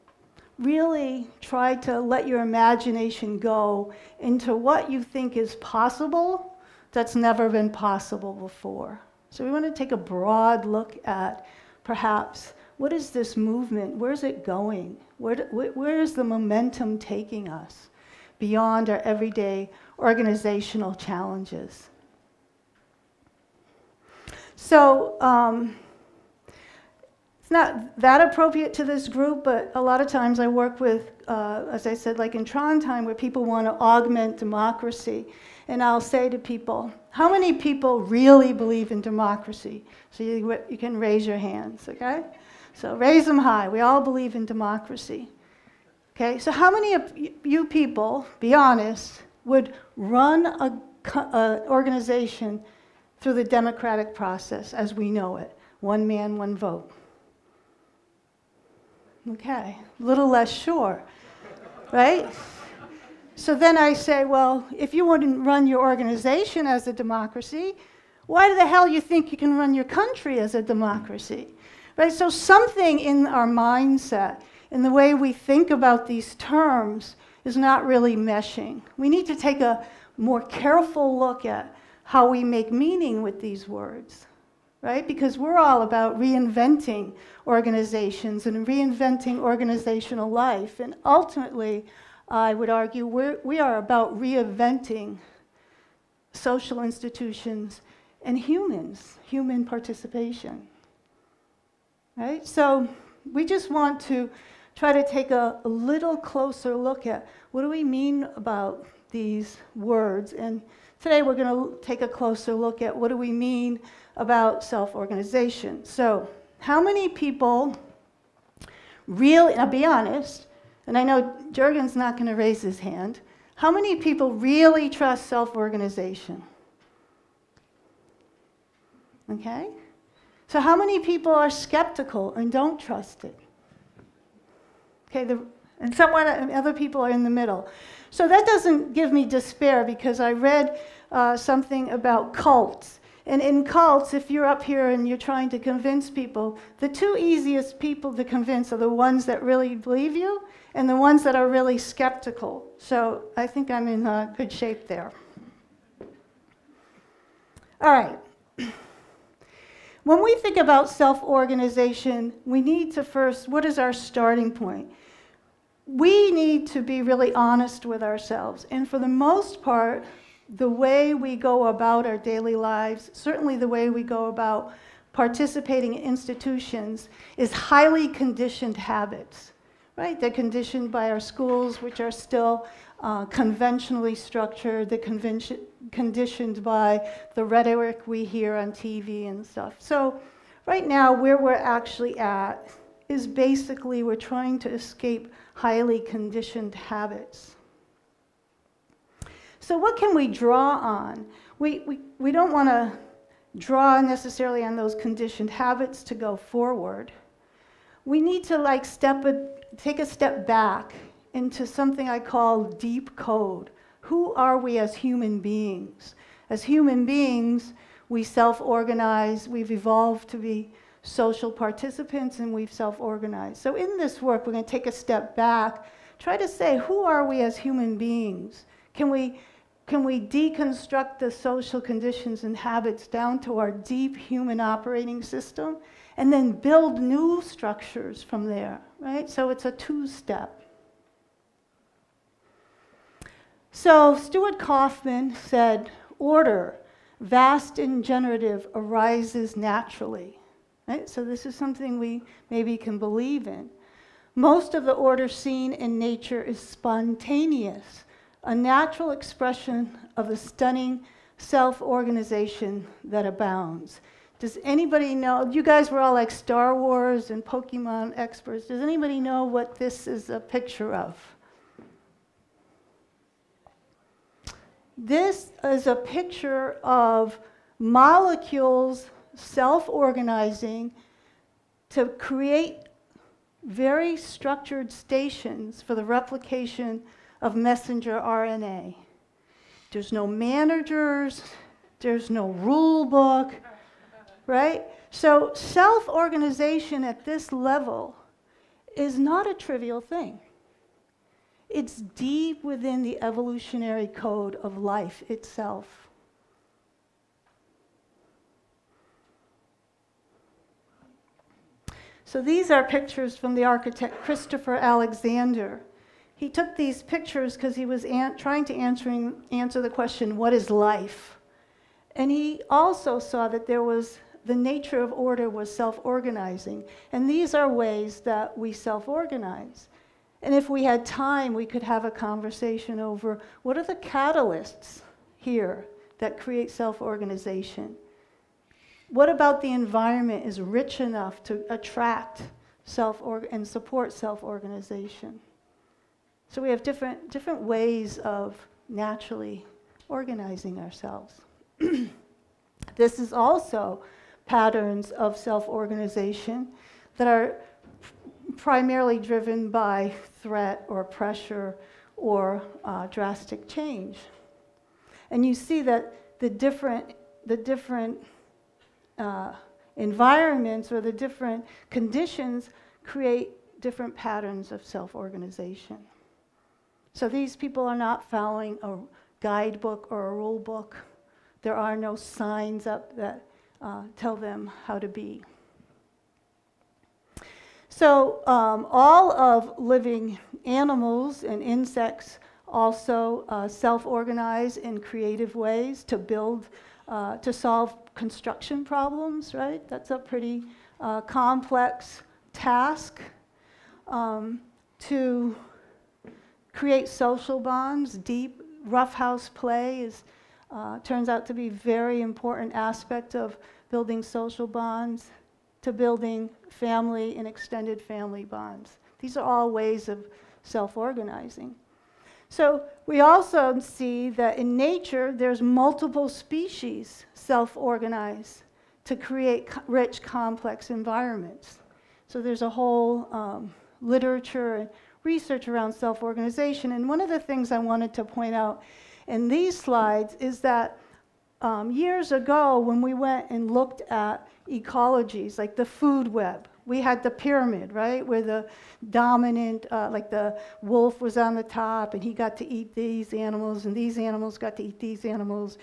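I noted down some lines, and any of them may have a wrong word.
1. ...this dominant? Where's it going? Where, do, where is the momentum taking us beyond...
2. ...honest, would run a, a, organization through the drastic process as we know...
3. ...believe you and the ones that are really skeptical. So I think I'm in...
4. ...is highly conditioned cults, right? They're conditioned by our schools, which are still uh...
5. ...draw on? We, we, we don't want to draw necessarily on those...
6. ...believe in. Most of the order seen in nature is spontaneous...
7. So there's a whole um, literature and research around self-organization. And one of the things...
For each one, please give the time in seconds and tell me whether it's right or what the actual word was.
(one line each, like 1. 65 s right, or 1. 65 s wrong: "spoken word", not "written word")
1. 13 s wrong: "movement", not "dominant"
2. 48 s wrong: "democratic", not "drastic"
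3. 149 s right
4. 177 s wrong: "habits", not "cults"
5. 200 s right
6. 252 s right
7. 432 s right.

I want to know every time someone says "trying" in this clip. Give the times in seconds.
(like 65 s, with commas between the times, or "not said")
145 s, 194 s, 318 s.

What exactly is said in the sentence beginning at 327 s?
And these are ways that we self organize.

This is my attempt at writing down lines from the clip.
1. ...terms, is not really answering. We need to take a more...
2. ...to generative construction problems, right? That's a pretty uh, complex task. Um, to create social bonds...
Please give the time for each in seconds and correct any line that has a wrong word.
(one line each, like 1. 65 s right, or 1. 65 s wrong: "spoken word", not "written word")
1. 76 s wrong: "meshing", not "answering"
2. 397 s wrong: "solve", not "generative".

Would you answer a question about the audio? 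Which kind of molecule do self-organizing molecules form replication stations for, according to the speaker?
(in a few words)
Messenger RNA.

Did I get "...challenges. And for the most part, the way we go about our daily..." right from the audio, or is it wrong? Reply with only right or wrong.
wrong.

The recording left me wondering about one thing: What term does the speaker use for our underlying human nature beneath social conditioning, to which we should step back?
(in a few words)
Deep code.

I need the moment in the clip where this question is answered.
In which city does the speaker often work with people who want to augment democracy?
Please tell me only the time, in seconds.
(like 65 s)
32 s.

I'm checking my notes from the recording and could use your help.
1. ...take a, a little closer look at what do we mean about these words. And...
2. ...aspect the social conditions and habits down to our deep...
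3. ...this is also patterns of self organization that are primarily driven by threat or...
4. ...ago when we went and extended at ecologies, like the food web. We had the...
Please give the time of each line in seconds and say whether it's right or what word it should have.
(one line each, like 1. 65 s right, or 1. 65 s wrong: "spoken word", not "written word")
1. 105 s right
2. 230 s wrong: "deconstruct", not "aspect"
3. 352 s right
4. 442 s wrong: "looked", not "extended".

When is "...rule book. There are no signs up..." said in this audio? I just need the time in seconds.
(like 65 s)
380 s.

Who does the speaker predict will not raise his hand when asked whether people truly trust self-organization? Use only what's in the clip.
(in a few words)
Jurgen.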